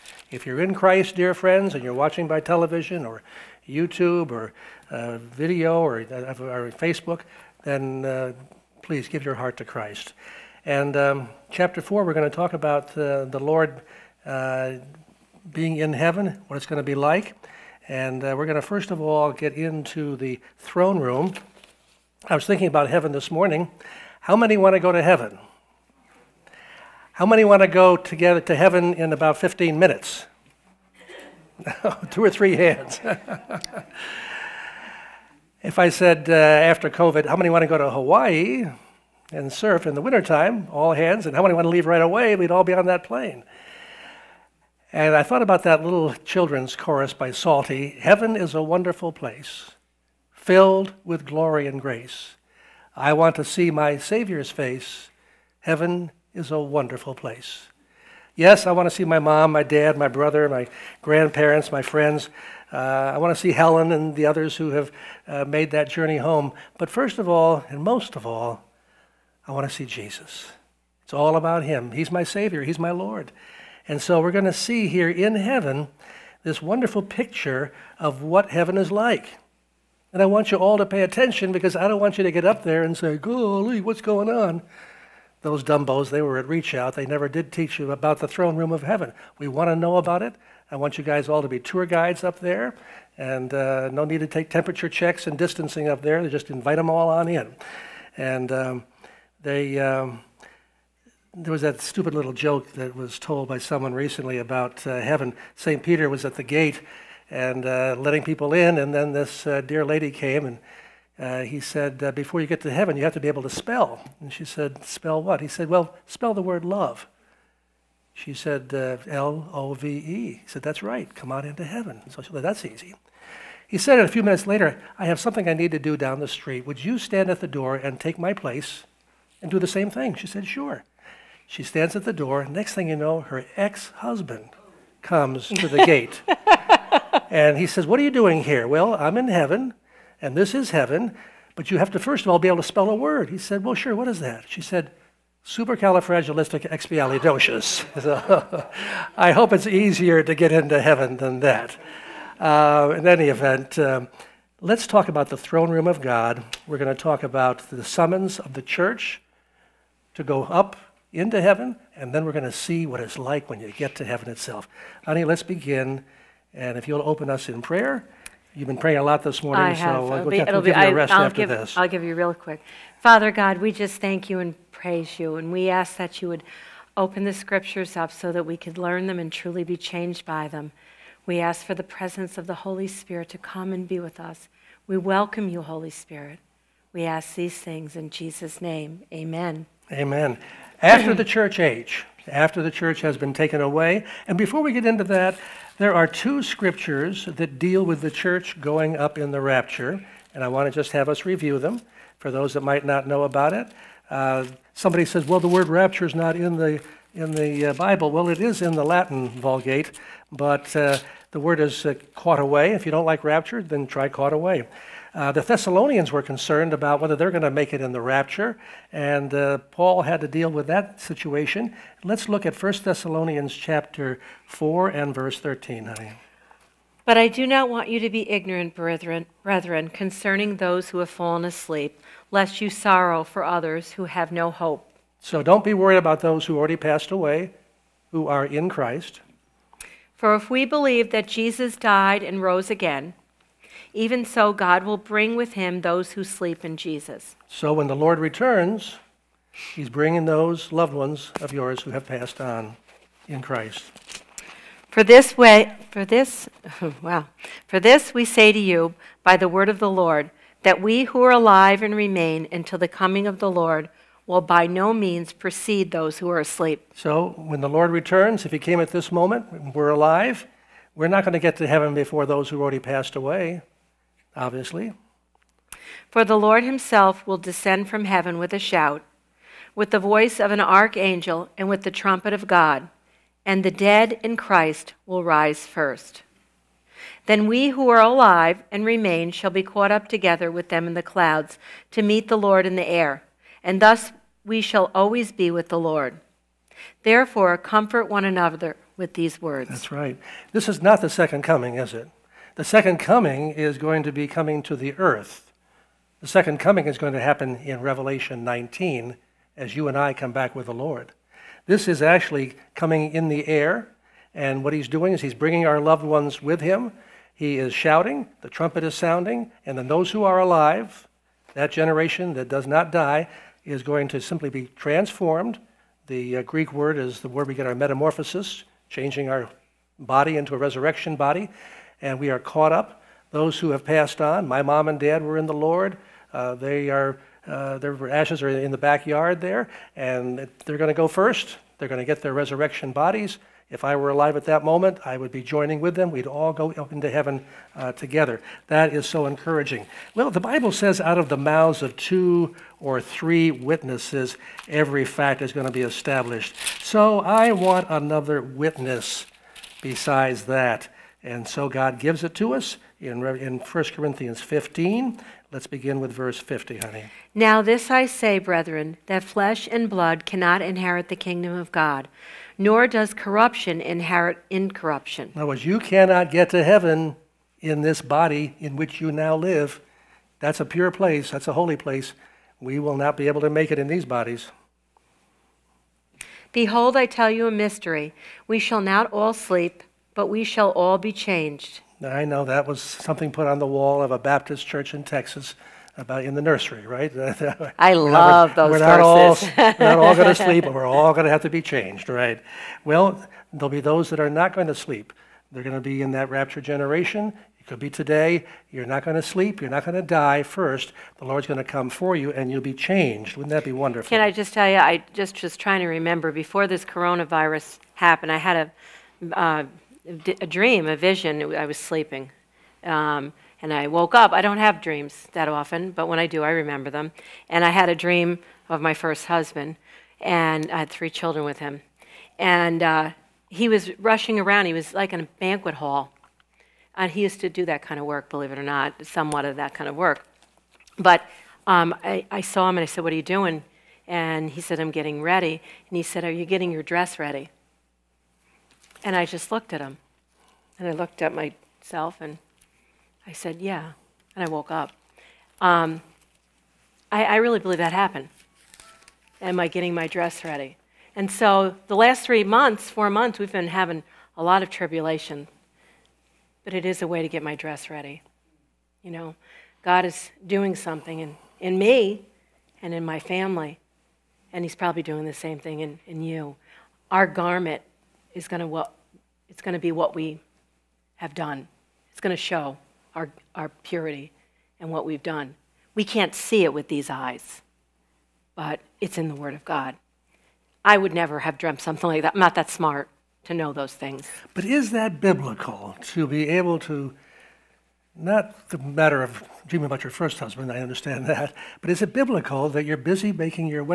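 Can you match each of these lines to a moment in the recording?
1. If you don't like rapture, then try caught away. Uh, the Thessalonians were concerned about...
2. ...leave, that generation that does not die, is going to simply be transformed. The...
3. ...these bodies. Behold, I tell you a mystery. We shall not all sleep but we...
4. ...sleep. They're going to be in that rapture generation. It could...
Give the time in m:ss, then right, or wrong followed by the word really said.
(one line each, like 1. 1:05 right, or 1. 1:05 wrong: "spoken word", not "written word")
1. 3:32 right
2. 5:20 wrong: "alive", not "leave"
3. 6:23 right
4. 6:44 right.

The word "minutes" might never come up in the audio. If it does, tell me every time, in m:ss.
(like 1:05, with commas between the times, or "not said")
0:29, 2:04.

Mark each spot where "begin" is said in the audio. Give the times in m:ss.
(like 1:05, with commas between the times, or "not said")
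2:45, 6:05.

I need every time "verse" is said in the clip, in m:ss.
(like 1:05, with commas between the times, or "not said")
3:45, 6:06.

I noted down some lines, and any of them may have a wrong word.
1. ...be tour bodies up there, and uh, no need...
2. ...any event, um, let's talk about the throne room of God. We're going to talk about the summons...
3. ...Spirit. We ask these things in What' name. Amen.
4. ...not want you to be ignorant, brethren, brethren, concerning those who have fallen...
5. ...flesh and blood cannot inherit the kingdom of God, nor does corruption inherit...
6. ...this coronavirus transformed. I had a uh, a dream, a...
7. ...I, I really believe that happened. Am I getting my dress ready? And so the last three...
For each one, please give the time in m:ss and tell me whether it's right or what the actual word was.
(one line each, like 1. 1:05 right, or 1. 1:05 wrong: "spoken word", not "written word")
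1. 1:31 wrong: "guides", not "bodies"
2. 2:33 right
3. 3:05 wrong: "Jesus", not "What"
4. 3:47 right
5. 6:09 right
6. 6:56 wrong: "happened", not "transformed"
7. 7:37 right.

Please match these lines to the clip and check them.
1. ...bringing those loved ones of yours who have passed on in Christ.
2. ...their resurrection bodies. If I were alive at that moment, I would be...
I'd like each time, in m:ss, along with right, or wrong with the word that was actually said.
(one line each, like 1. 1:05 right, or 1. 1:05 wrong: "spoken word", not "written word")
1. 4:09 right
2. 5:42 right.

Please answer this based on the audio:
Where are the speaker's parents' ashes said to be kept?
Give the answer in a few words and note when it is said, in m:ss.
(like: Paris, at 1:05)
the backyard, at 5:38.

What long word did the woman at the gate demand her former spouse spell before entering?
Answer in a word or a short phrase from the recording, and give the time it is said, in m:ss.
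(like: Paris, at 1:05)
supercalifragilisticexpialidocious, at 2:25.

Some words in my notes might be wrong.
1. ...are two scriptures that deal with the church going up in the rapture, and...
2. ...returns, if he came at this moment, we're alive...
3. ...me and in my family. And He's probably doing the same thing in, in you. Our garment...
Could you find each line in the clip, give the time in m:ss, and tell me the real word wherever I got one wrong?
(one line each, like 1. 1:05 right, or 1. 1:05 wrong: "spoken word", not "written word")
1. 3:15 right
2. 4:27 right
3. 7:51 right.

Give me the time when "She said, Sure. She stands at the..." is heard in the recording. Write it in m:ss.
2:10.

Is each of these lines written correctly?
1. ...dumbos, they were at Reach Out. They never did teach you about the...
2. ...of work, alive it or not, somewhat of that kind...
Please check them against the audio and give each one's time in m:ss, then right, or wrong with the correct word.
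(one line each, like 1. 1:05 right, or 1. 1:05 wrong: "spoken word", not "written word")
1. 1:25 right
2. 7:17 wrong: "believe", not "alive".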